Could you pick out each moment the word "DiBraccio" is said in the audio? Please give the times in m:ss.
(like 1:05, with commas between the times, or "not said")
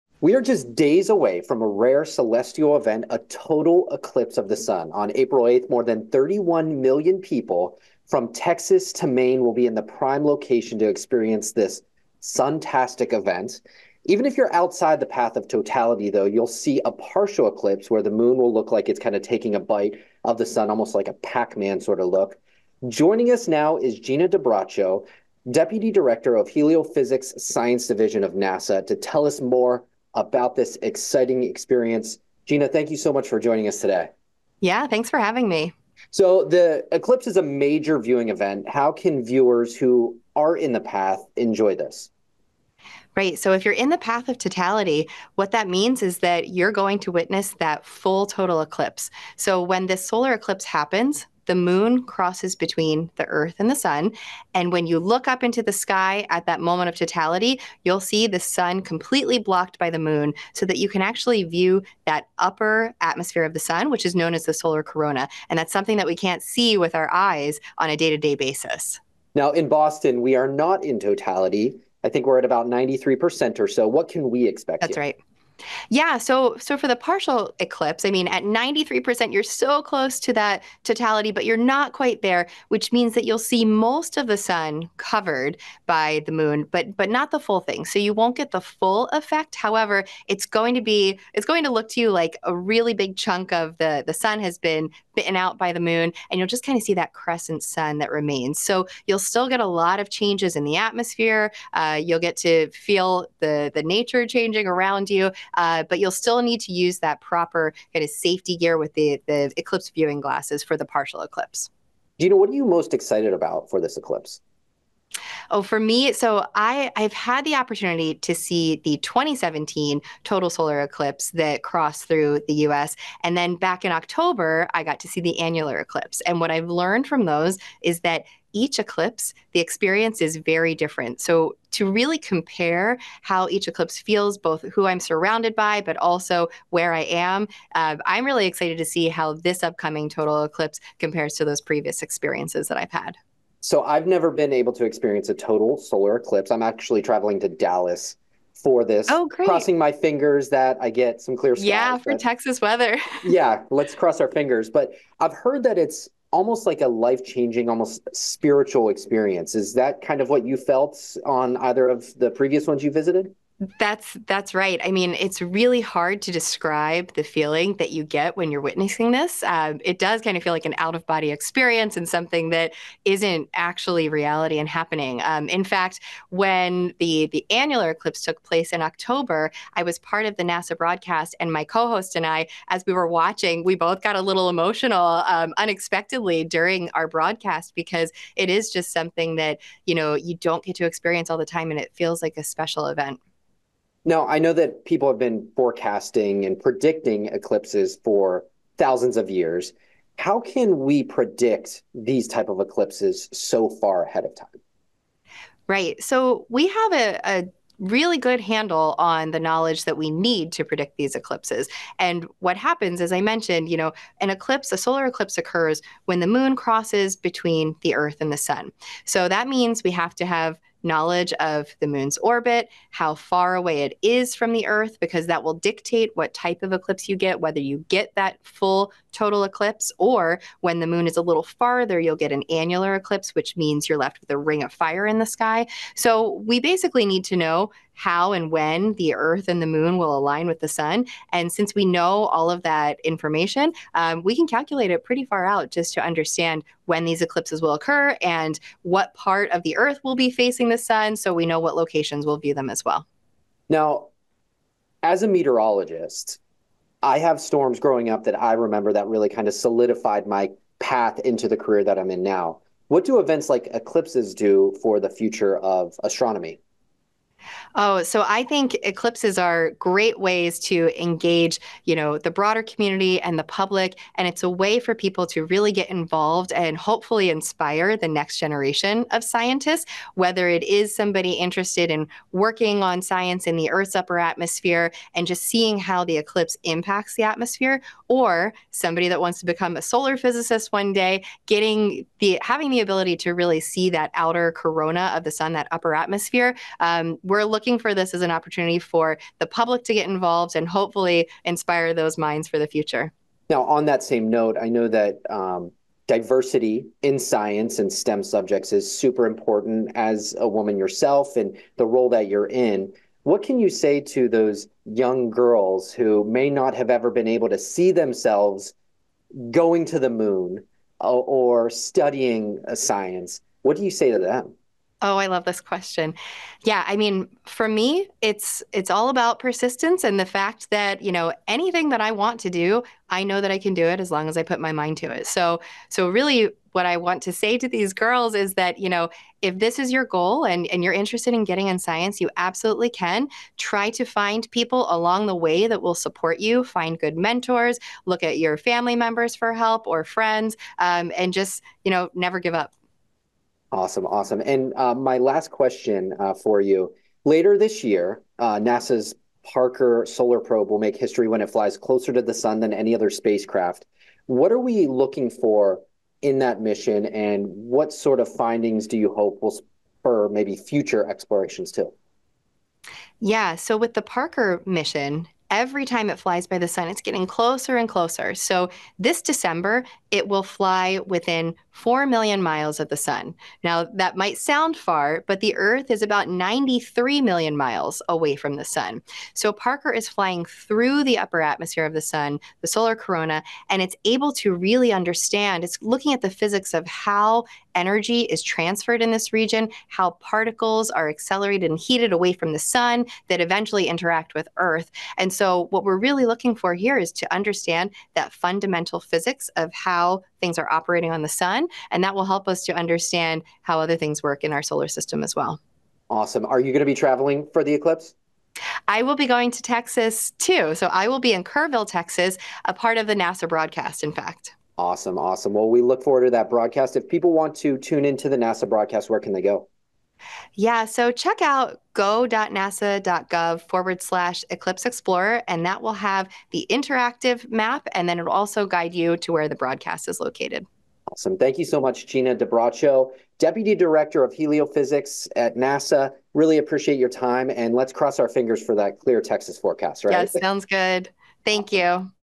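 0:24, 7:22.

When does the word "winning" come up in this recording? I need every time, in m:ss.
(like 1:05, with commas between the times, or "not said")
not said.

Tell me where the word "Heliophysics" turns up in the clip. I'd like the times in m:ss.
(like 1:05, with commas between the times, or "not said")
0:26, 7:24.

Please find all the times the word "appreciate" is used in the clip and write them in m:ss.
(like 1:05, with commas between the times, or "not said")
7:26.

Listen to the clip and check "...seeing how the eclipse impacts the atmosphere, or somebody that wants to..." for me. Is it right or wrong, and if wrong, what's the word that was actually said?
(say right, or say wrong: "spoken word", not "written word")
right.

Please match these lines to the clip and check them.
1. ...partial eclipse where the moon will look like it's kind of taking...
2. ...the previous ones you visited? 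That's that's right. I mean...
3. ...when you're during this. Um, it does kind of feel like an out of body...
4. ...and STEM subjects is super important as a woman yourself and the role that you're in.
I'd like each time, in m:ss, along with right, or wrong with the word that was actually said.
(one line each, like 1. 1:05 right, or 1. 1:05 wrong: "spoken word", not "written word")
1. 0:16 right
2. 2:42 right
3. 2:48 wrong: "witnessing", not "during"
4. 5:07 right.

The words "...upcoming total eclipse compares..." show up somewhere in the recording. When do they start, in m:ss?
2:19.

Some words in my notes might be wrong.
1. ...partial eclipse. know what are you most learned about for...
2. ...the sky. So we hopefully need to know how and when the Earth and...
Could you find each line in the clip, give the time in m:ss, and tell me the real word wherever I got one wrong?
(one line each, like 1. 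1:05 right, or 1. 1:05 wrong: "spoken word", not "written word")
1. 1:50 wrong: "excited", not "learned"
2. 3:55 wrong: "basically", not "hopefully".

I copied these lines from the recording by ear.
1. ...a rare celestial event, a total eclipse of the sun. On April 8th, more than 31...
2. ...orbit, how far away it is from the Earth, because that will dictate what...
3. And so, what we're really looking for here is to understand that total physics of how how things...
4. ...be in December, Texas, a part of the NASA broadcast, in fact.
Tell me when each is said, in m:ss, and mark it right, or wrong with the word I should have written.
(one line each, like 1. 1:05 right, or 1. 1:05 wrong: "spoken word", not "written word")
1. 0:01 right
2. 3:42 right
3. 6:45 wrong: "fundamental", not "total"
4. 7:01 wrong: "Kerrville", not "December".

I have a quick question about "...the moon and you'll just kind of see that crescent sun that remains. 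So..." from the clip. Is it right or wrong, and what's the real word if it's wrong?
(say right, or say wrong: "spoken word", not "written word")
right.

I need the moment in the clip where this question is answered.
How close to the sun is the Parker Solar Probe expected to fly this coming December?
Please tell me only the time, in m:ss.
6:21.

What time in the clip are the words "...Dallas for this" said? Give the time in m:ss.
2:27.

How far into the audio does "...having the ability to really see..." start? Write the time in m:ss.
4:52.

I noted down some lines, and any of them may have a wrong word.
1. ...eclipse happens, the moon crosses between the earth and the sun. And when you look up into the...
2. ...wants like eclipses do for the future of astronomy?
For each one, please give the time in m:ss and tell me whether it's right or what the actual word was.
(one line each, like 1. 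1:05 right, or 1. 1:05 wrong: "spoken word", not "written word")
1. 0:50 right
2. 4:23 wrong: "events", not "wants".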